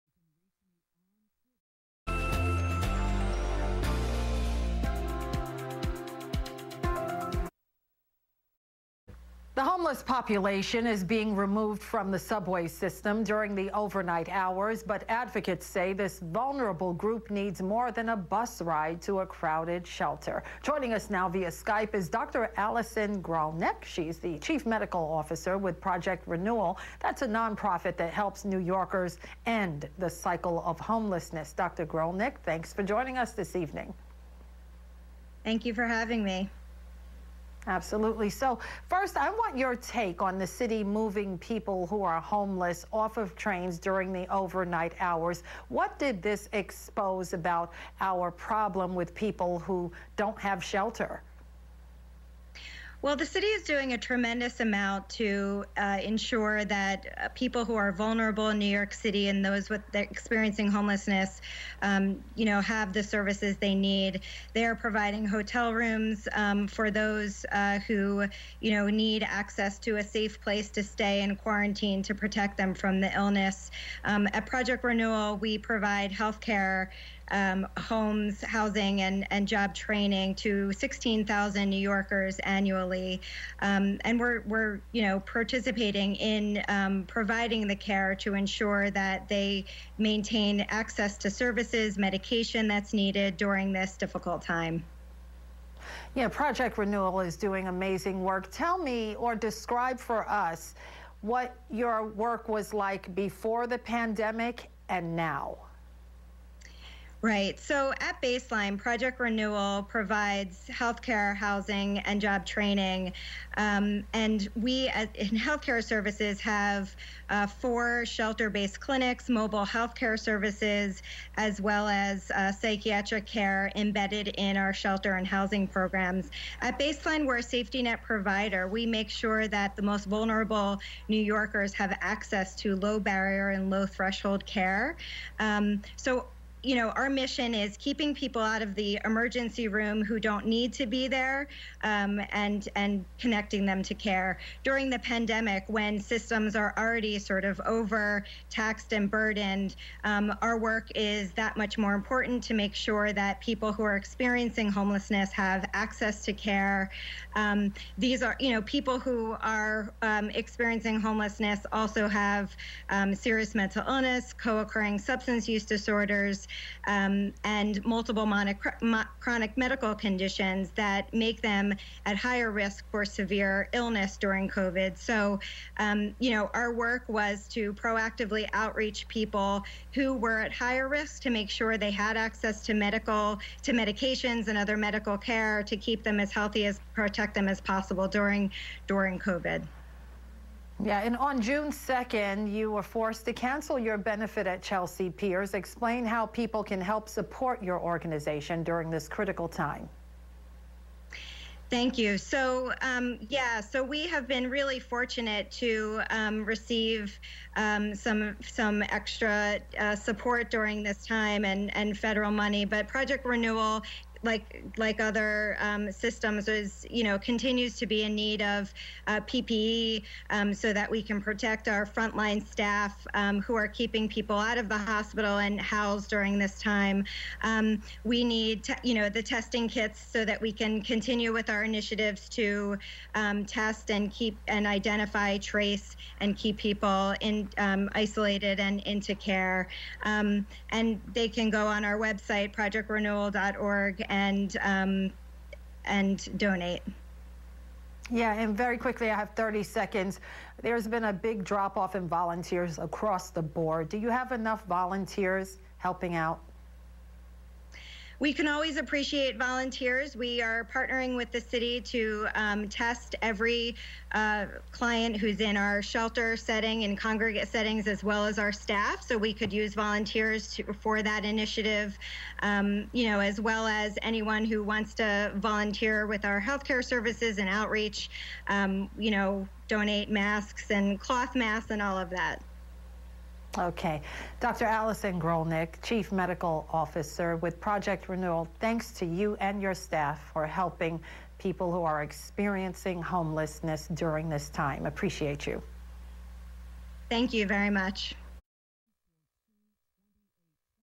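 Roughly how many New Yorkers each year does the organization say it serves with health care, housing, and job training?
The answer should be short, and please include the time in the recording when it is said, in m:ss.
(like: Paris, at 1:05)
16,000, at 1:20.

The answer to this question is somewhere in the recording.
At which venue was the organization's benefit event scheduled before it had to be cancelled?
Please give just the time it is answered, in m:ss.
3:14.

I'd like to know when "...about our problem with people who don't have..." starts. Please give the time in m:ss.
0:47.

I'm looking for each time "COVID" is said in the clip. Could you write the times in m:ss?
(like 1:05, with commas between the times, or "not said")
2:54, 3:09.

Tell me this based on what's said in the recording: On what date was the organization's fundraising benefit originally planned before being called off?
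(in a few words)
June 2.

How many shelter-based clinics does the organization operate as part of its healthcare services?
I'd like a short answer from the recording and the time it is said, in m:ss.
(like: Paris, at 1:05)
4, at 1:57.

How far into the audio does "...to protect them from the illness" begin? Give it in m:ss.
1:12.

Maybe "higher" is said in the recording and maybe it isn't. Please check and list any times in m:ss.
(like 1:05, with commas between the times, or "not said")
2:52, 3:00.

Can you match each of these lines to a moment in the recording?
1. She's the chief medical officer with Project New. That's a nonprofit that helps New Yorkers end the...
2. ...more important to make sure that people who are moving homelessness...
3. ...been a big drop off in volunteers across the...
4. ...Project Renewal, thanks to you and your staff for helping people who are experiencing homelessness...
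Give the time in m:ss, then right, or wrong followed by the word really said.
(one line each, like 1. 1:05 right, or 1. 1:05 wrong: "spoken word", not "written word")
1. 0:23 wrong: "Renewal", not "New"
2. 2:31 wrong: "experiencing", not "moving"
3. 4:10 right
4. 4:47 right.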